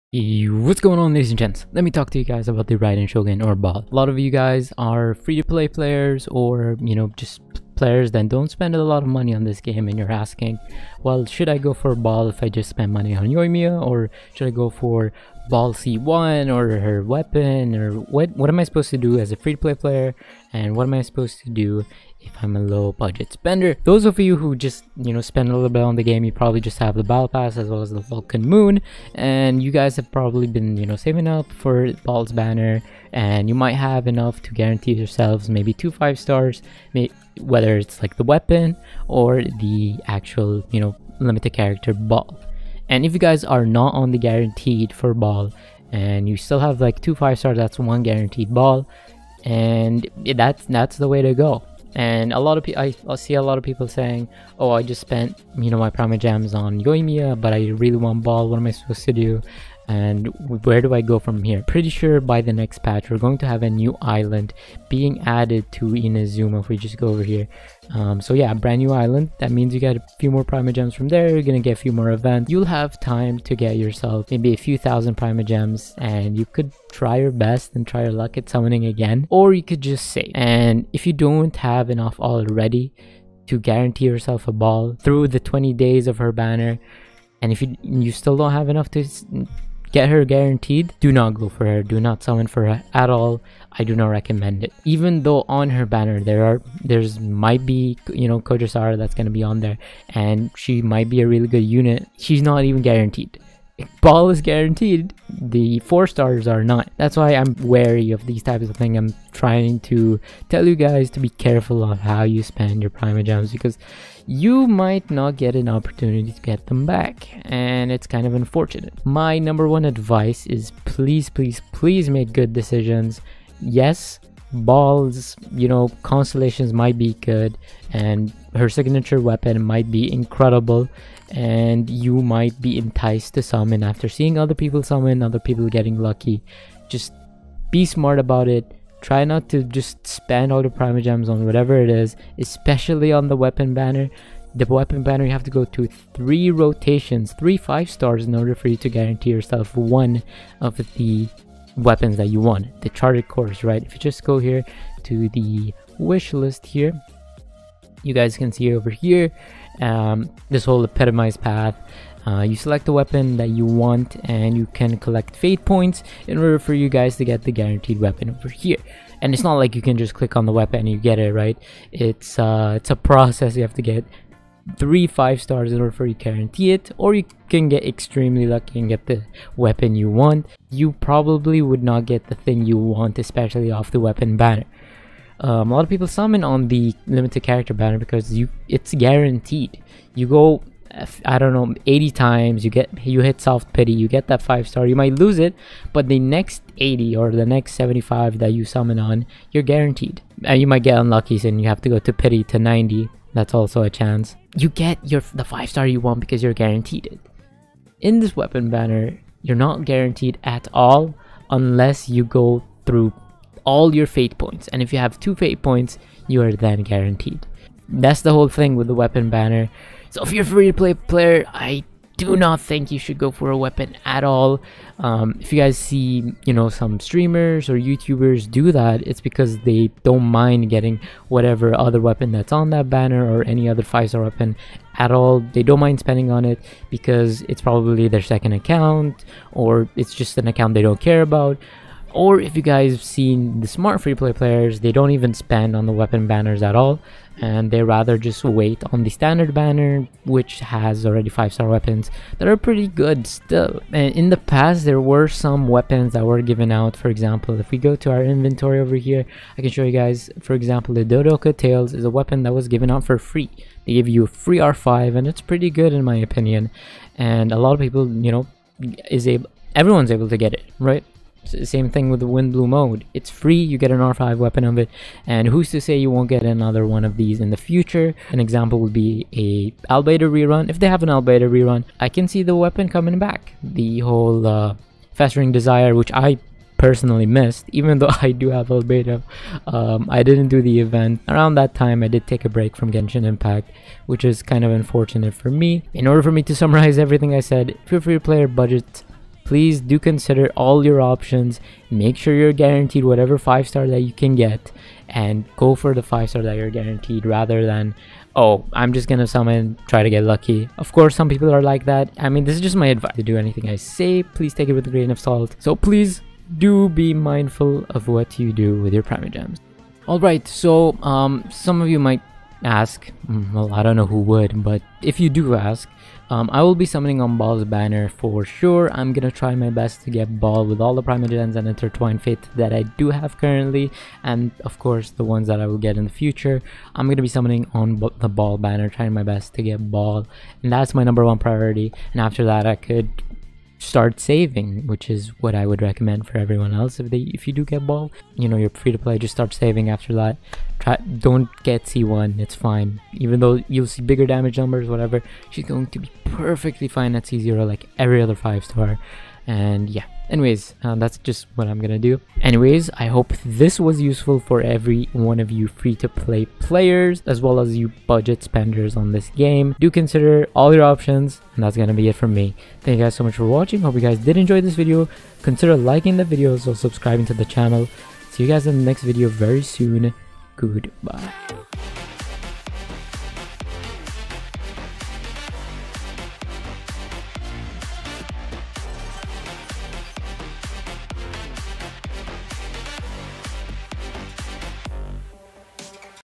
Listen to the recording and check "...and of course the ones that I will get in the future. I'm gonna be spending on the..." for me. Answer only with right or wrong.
wrong.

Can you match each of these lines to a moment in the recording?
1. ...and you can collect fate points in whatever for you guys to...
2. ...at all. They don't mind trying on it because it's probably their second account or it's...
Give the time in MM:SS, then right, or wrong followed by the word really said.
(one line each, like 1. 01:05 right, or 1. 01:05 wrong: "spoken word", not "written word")
1. 02:44 wrong: "order", not "whatever"
2. 03:54 wrong: "spending", not "trying".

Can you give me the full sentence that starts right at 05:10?
Of course, some people are like that.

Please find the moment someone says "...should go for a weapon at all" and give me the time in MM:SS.
03:42.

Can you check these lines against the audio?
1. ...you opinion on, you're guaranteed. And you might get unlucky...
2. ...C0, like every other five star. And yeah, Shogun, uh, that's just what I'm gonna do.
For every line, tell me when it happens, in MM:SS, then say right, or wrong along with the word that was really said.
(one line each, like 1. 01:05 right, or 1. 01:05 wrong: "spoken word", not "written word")
1. 03:18 wrong: "summon", not "opinion"
2. 05:57 wrong: "Anyways", not "Shogun".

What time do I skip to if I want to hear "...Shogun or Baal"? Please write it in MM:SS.
00:03.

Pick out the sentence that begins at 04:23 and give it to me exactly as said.
They give you a free R5, and it's pretty good in my opinion.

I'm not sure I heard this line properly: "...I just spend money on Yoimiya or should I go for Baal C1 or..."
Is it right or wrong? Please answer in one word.
right.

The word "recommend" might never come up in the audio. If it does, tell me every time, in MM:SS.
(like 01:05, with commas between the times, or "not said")
01:34, 05:45.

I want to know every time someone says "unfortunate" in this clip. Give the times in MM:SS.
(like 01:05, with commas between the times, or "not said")
01:58, 04:54.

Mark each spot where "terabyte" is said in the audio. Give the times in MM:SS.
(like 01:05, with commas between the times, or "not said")
not said.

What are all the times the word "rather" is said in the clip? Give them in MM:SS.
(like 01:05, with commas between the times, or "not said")
04:07, 05:07.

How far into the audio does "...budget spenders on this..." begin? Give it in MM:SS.
06:08.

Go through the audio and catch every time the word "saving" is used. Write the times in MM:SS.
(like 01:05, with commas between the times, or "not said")
00:30, 05:44, 05:49.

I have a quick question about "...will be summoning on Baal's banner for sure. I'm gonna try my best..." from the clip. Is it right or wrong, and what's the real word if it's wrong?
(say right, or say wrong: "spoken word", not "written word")
right.